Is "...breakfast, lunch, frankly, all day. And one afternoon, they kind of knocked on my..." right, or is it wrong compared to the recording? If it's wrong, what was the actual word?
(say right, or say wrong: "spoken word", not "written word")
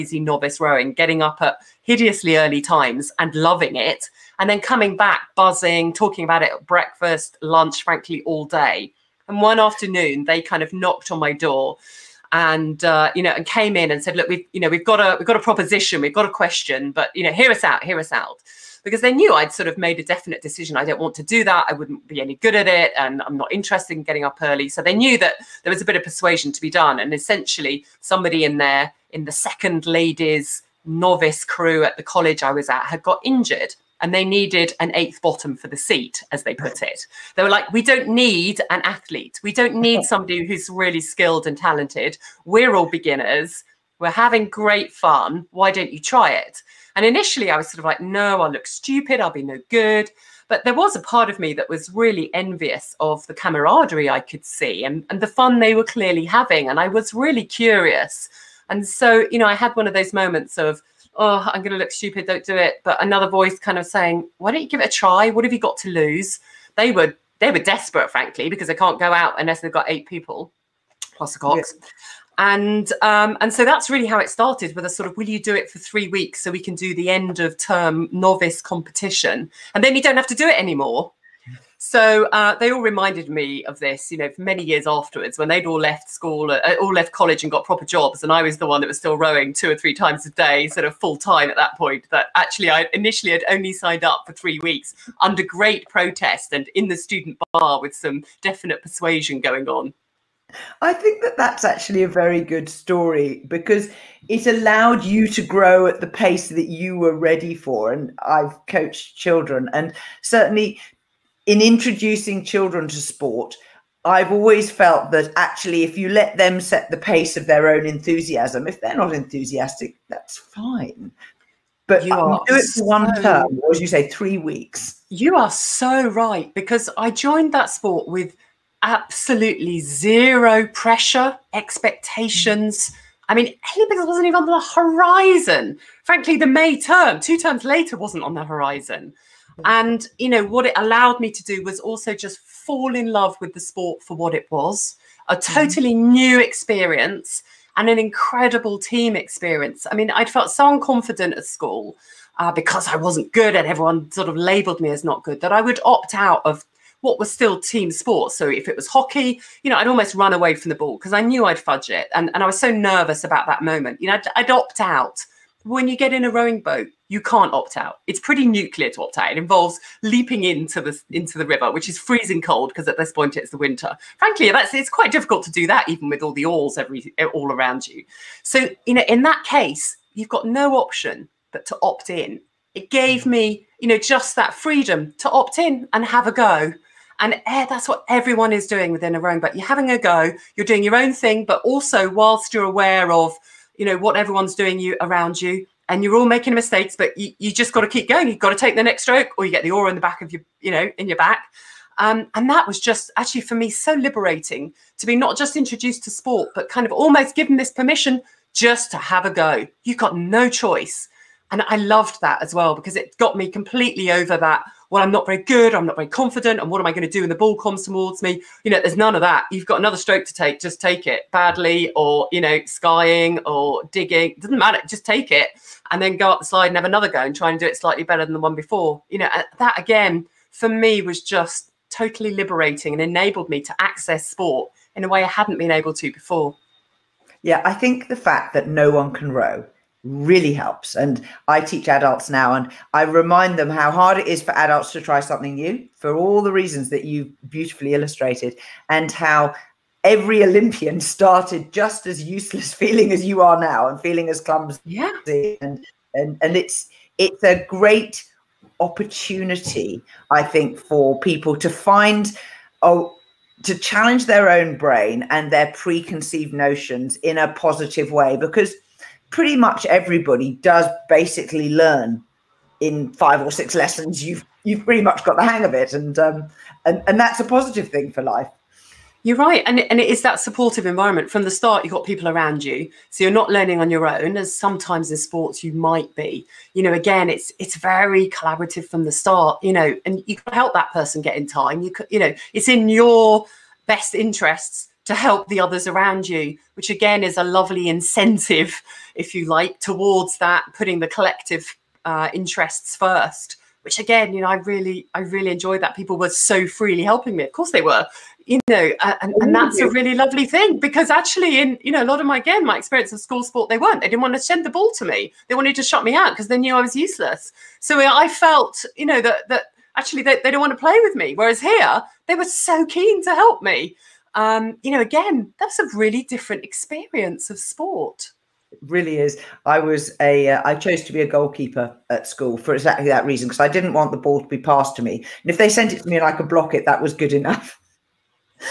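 right.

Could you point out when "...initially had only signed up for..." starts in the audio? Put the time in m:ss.
1:32.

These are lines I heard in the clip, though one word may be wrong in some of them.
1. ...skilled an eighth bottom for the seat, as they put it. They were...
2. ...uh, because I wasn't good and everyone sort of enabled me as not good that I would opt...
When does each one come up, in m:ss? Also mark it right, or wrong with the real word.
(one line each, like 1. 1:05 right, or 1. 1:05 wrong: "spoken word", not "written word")
1. 0:34 wrong: "needed", not "skilled"
2. 2:32 wrong: "labeled", not "enabled".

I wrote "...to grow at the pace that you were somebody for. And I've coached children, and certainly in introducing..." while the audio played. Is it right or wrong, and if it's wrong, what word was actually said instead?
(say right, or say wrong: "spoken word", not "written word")
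wrong: "ready", not "somebody".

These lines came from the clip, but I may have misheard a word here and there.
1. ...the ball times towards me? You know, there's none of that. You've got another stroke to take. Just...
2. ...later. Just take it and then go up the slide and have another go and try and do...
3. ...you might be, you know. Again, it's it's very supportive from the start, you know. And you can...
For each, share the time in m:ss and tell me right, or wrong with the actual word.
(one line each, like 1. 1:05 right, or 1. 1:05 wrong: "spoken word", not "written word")
1. 3:37 wrong: "comes", not "times"
2. 3:44 wrong: "matter", not "later"
3. 4:45 wrong: "collaborative", not "supportive".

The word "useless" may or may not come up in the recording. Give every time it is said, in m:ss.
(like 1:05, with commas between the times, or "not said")
4:12, 5:16.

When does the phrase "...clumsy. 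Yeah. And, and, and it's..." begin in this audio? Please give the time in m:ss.
4:14.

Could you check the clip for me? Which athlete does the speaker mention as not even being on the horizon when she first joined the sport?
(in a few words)
Haley Biggs.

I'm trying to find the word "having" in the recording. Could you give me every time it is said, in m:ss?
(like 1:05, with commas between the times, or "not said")
0:44, 0:56, 3:09.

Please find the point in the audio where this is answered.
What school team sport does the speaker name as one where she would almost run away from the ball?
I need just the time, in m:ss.
2:38.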